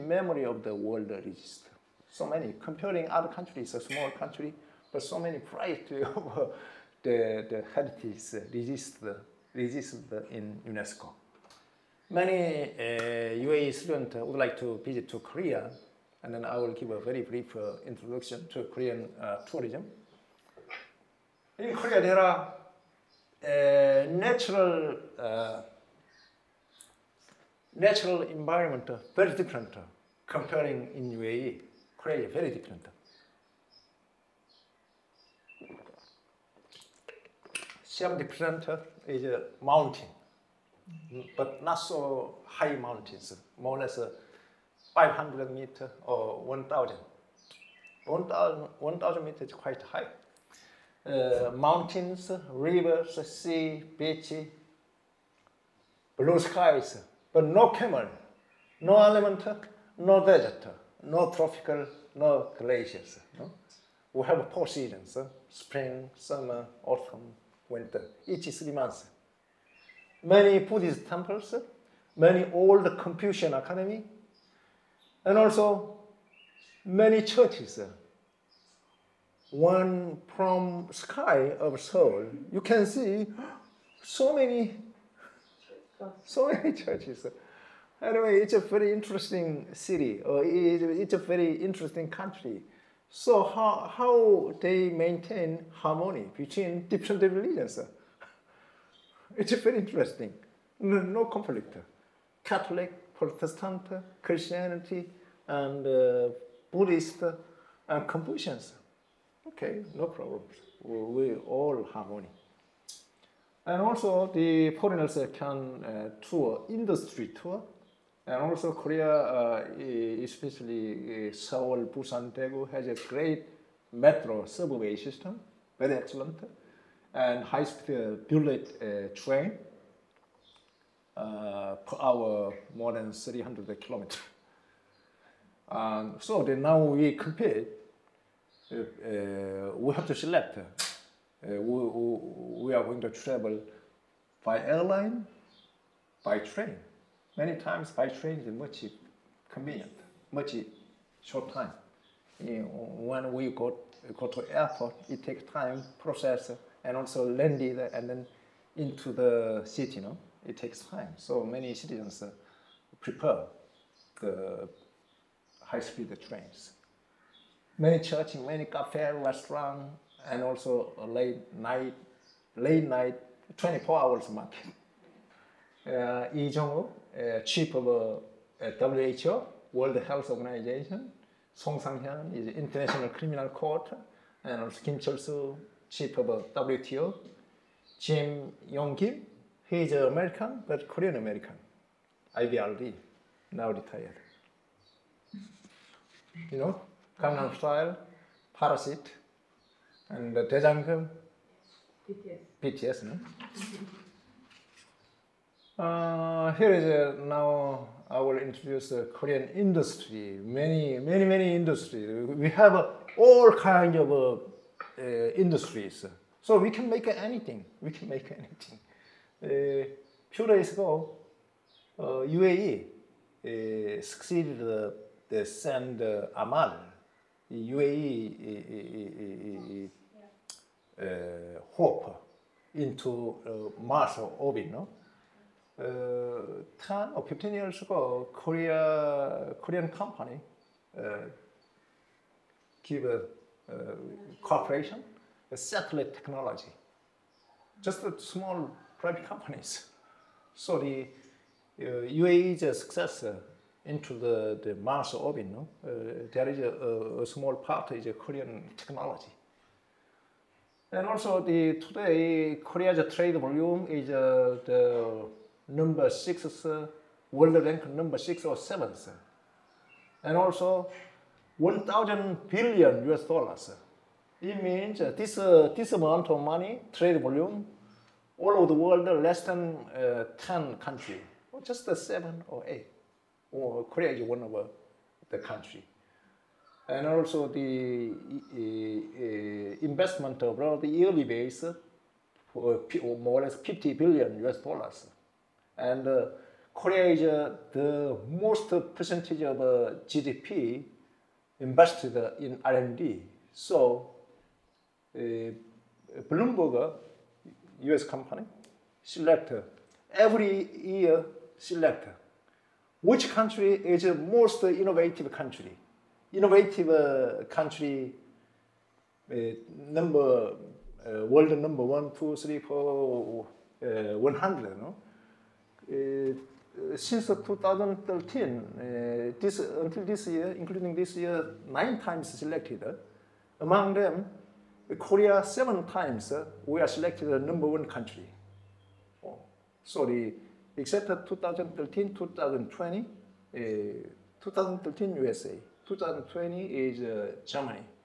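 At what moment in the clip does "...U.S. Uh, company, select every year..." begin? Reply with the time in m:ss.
5:07.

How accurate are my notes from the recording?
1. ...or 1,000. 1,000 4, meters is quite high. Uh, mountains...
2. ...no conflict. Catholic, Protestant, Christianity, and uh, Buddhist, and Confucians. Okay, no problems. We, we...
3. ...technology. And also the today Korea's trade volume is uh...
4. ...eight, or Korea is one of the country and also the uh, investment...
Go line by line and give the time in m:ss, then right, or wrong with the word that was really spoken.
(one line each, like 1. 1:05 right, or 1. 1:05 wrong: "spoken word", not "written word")
1. 0:46 wrong: "1", not "4"
2. 1:41 right
3. 4:18 right
4. 4:42 right.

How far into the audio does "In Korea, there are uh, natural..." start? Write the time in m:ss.
0:21.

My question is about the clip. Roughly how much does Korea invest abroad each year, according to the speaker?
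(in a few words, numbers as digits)
50 billion US dollars.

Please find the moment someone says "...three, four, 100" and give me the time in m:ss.
5:22.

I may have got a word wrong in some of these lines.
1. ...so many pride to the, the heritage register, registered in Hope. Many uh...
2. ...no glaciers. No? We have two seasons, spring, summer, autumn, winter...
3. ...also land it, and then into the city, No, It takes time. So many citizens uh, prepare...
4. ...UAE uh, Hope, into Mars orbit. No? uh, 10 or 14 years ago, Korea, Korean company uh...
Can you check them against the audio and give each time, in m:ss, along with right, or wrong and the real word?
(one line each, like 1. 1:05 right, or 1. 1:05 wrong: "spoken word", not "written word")
1. 0:05 wrong: "UNESCO", not "Hope"
2. 1:02 wrong: "four", not "two"
3. 2:36 right
4. 3:47 wrong: "15", not "14".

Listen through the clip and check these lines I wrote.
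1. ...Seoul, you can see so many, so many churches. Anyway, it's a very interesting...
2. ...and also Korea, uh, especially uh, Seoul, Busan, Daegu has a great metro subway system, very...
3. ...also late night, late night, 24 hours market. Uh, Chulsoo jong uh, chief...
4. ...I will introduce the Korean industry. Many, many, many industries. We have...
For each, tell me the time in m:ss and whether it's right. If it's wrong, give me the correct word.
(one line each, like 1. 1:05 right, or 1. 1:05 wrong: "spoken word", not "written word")
1. 1:21 right
2. 1:58 right
3. 2:50 wrong: "Lee", not "Chulsoo"
4. 3:28 right.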